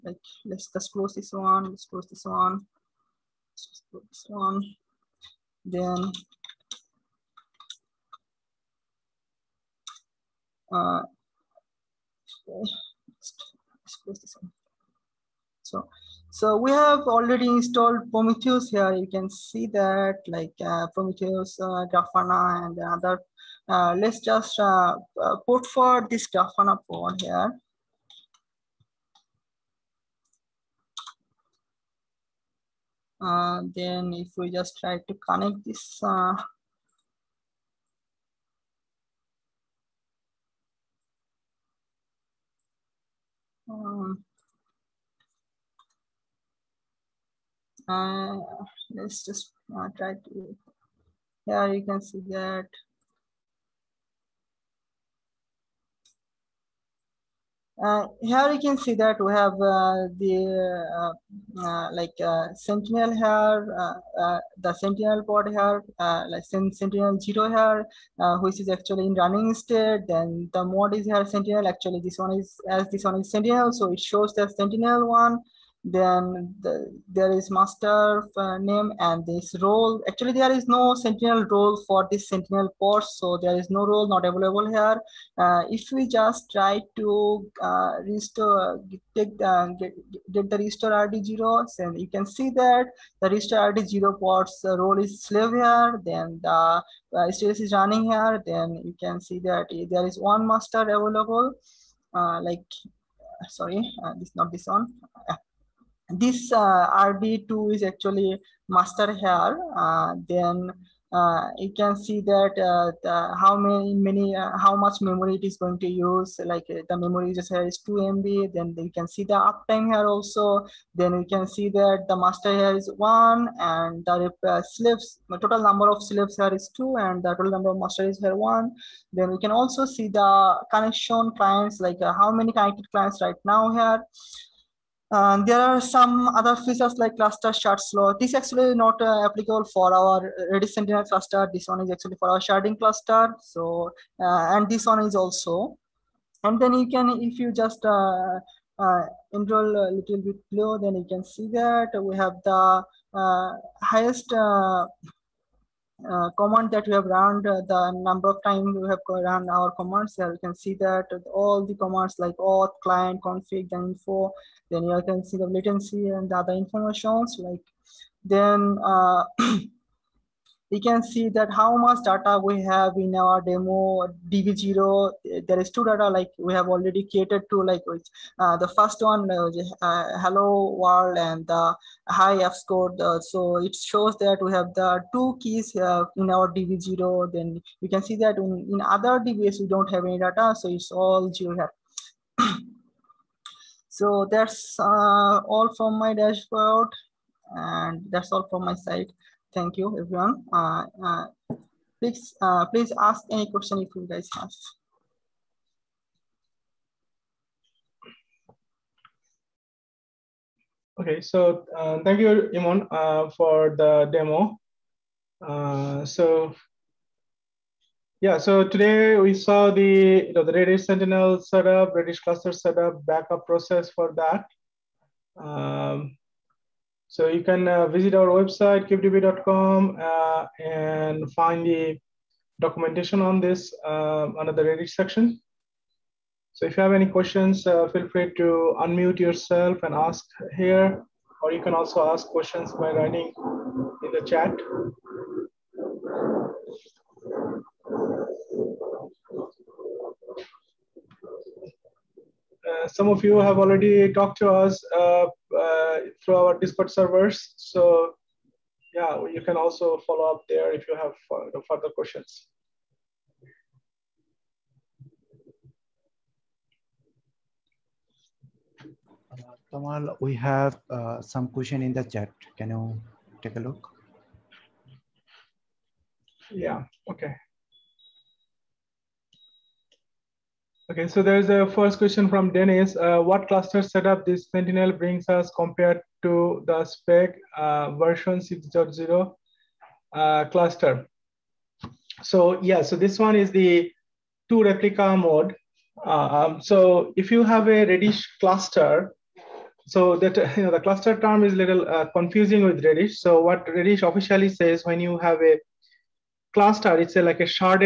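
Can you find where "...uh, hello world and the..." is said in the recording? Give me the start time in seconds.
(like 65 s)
179 s.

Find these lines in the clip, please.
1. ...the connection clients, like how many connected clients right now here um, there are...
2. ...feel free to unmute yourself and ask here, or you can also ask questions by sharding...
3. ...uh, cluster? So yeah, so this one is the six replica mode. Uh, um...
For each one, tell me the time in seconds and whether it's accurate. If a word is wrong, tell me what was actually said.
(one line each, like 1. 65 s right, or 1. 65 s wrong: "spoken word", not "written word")
1. 130 s right
2. 237 s wrong: "writing", not "sharding"
3. 290 s wrong: "two", not "six".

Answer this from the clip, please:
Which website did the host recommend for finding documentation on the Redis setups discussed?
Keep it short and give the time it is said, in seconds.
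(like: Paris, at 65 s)
kubedb.com, at 228 s.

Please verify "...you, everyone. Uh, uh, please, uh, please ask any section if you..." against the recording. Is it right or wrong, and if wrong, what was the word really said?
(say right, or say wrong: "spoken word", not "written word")
wrong: "question", not "section".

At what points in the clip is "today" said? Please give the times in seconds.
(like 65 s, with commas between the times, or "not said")
218 s.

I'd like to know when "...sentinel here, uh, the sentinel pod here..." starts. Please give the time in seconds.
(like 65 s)
62 s.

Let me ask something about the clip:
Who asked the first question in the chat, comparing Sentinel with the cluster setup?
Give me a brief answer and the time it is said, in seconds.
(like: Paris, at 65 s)
Dennis, at 282 s.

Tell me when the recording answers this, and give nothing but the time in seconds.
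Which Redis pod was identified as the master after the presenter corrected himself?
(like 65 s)
106 s.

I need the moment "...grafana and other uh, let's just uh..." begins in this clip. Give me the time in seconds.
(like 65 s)
21 s.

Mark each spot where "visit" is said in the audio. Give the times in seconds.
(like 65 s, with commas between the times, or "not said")
227 s.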